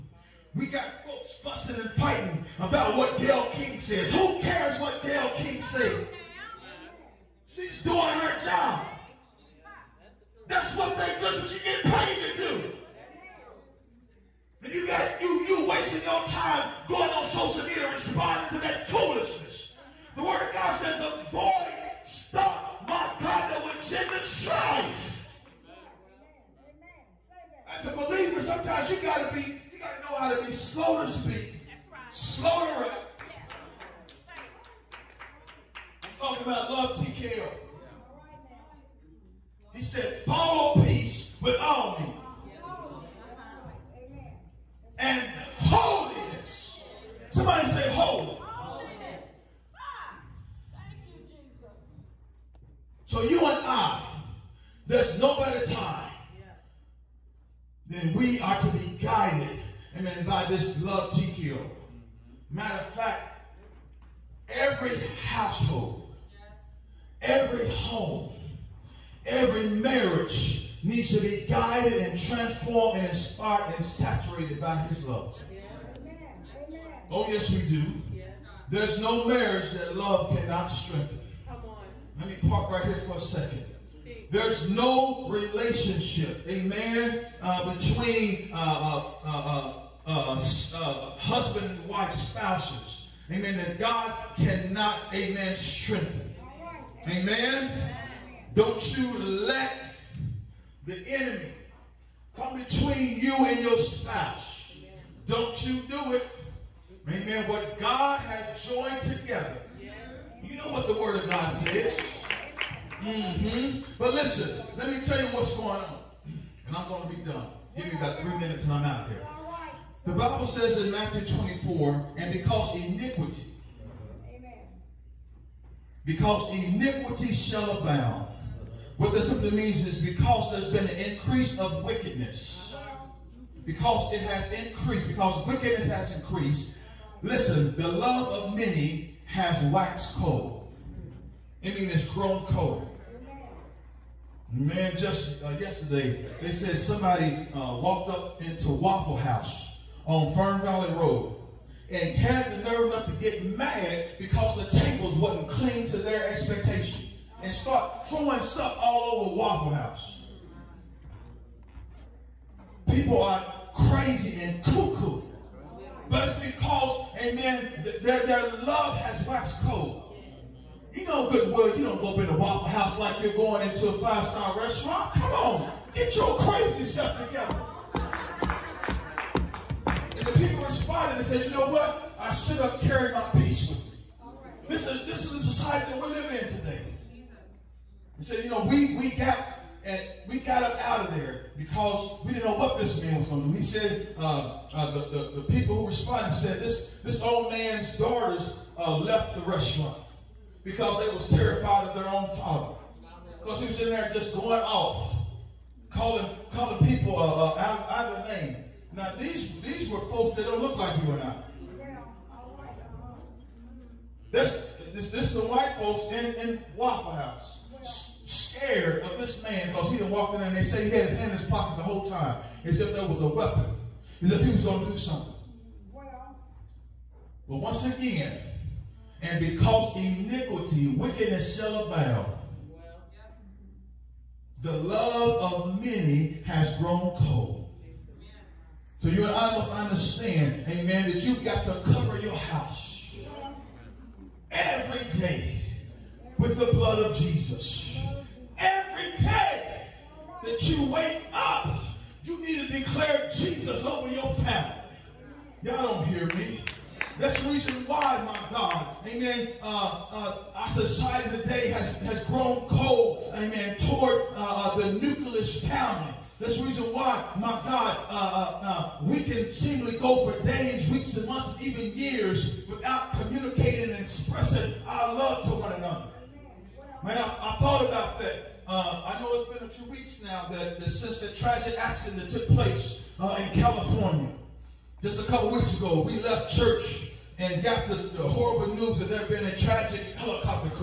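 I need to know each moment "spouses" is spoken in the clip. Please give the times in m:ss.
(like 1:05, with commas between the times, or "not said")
1:32, 1:43.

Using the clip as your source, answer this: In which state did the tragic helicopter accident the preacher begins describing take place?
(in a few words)
California.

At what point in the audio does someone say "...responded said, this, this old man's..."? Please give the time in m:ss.
3:15.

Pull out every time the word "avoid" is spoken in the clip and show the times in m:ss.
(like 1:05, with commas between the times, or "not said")
0:20.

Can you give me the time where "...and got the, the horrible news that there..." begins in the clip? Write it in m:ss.
4:47.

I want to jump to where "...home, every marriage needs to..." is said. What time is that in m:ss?
1:07.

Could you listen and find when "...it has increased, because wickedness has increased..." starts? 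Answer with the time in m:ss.
2:14.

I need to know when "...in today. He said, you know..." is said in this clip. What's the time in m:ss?
3:06.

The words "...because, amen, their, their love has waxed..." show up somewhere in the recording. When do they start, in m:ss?
2:46.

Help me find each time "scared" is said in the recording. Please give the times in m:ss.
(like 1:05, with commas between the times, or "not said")
3:38.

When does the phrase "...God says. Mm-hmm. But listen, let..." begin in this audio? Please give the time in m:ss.
1:51.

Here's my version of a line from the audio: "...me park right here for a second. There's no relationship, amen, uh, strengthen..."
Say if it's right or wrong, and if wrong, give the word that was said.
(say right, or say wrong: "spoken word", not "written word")
wrong: "between", not "strengthen".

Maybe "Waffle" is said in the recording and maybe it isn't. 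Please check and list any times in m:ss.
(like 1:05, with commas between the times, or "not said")
2:28, 2:39, 2:52, 3:36.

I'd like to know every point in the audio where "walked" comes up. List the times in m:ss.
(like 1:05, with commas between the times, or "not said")
2:27, 3:40.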